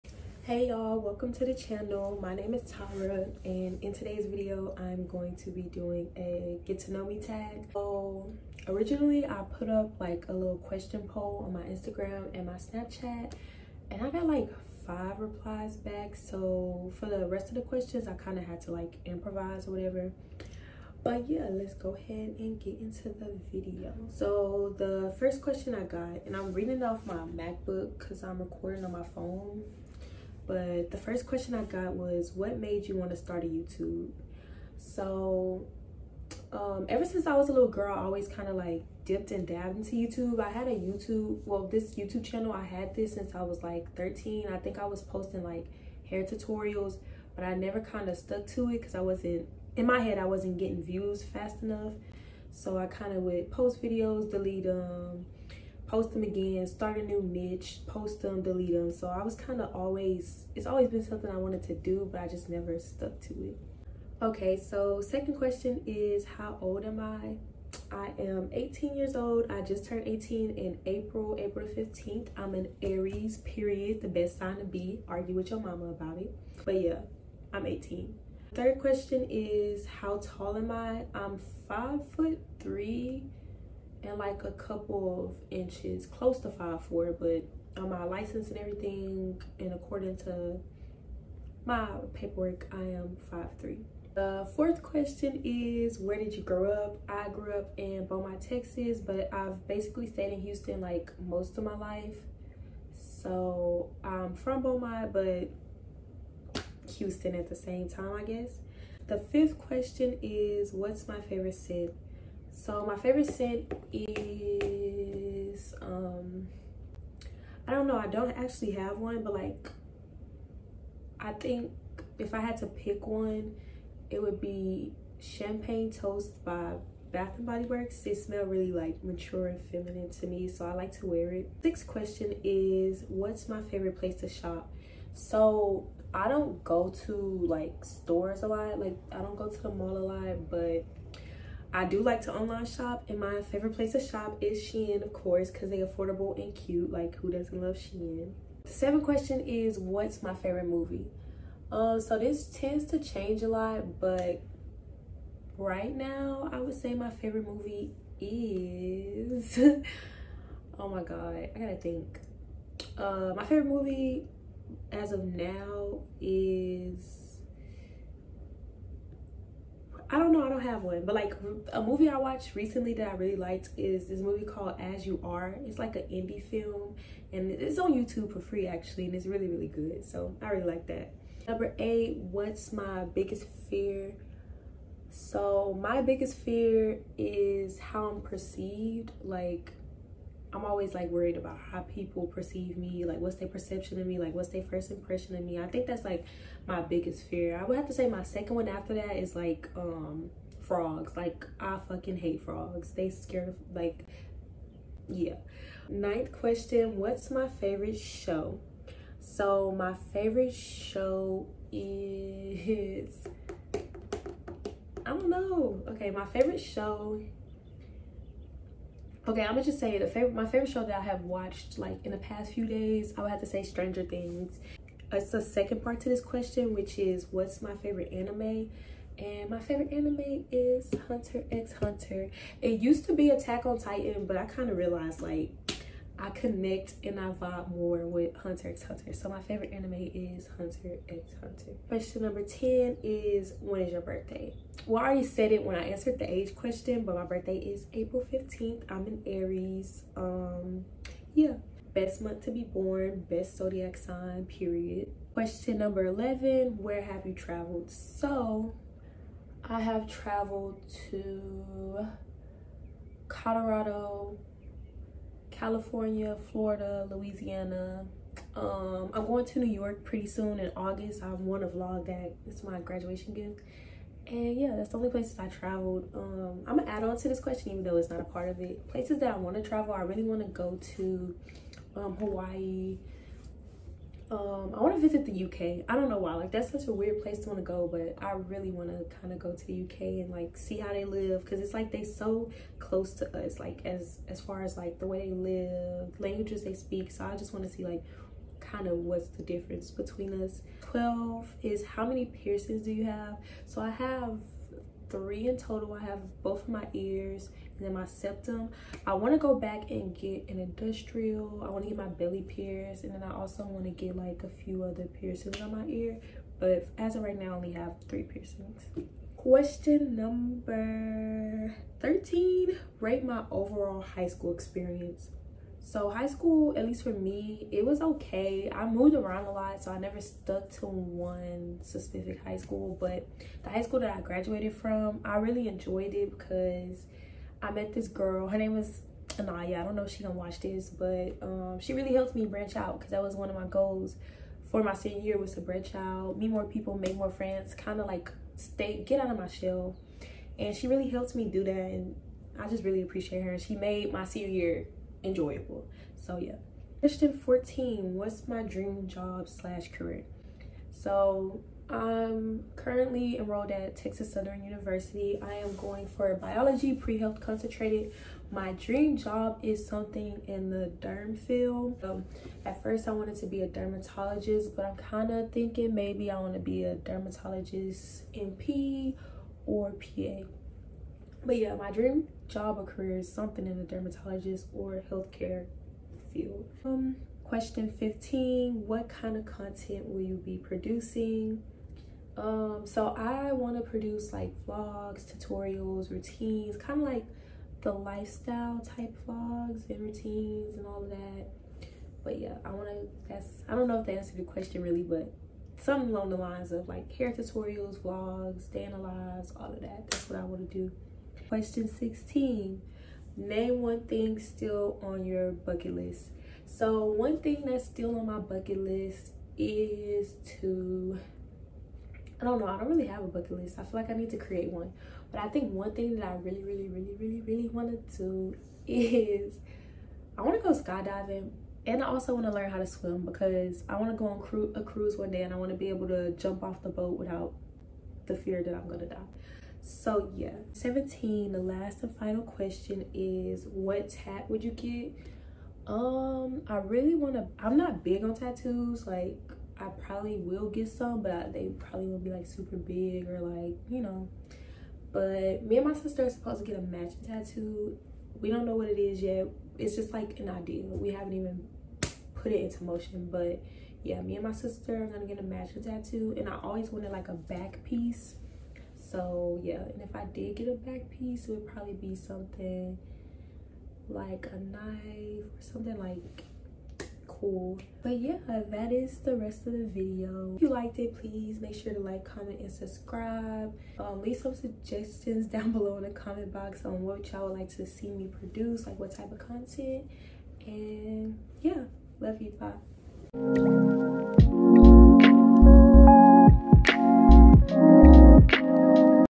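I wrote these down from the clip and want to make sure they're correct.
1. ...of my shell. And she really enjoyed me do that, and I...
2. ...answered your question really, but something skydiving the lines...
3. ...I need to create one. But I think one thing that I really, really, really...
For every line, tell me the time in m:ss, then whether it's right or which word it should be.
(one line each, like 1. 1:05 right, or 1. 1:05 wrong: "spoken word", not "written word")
1. 5:49 wrong: "helped", not "enjoyed"
2. 6:44 wrong: "along", not "skydiving"
3. 7:04 right.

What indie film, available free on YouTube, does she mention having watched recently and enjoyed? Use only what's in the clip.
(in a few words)
As You Are.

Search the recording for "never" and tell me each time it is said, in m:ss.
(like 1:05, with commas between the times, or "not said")
0:47, 1:02, 5:29.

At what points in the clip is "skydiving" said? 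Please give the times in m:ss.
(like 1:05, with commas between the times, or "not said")
7:10.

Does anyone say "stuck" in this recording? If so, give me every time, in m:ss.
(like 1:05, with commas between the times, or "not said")
0:48, 1:02, 5:30.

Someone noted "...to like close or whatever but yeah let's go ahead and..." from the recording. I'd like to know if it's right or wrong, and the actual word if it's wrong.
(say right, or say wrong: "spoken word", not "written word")
wrong: "improvise", not "close".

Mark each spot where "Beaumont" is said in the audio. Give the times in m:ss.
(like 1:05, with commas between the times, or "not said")
1:38, 1:44.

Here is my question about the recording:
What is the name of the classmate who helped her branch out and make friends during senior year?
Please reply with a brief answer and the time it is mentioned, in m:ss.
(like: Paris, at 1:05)
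Anaya, at 5:39.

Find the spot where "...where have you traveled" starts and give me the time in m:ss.
4:16.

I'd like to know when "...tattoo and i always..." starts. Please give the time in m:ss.
7:45.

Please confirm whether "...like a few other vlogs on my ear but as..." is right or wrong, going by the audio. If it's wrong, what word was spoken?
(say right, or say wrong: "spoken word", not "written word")
wrong: "piercings", not "vlogs".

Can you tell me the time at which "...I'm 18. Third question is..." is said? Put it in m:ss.
1:17.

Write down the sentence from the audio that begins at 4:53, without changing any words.
Like as as far as like the way they live, languages they speak.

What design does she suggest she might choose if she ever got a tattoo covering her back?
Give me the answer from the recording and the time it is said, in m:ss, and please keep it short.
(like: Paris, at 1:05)
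A knife, at 7:54.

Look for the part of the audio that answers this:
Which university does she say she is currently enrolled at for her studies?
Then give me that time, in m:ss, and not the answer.
6:03.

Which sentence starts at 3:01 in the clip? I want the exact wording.
Number eight, what's my biggest fear?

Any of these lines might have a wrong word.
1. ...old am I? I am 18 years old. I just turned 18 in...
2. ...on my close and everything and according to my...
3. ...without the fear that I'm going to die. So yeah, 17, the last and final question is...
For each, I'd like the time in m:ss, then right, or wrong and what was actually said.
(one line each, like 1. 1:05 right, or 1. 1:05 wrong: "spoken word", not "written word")
1. 1:06 right
2. 1:27 wrong: "license", not "close"
3. 7:17 right.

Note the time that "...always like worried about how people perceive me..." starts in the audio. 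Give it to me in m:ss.
3:10.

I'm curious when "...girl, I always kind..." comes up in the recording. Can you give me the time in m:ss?
0:37.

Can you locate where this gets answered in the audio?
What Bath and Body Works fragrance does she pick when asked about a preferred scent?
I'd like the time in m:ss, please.
2:05.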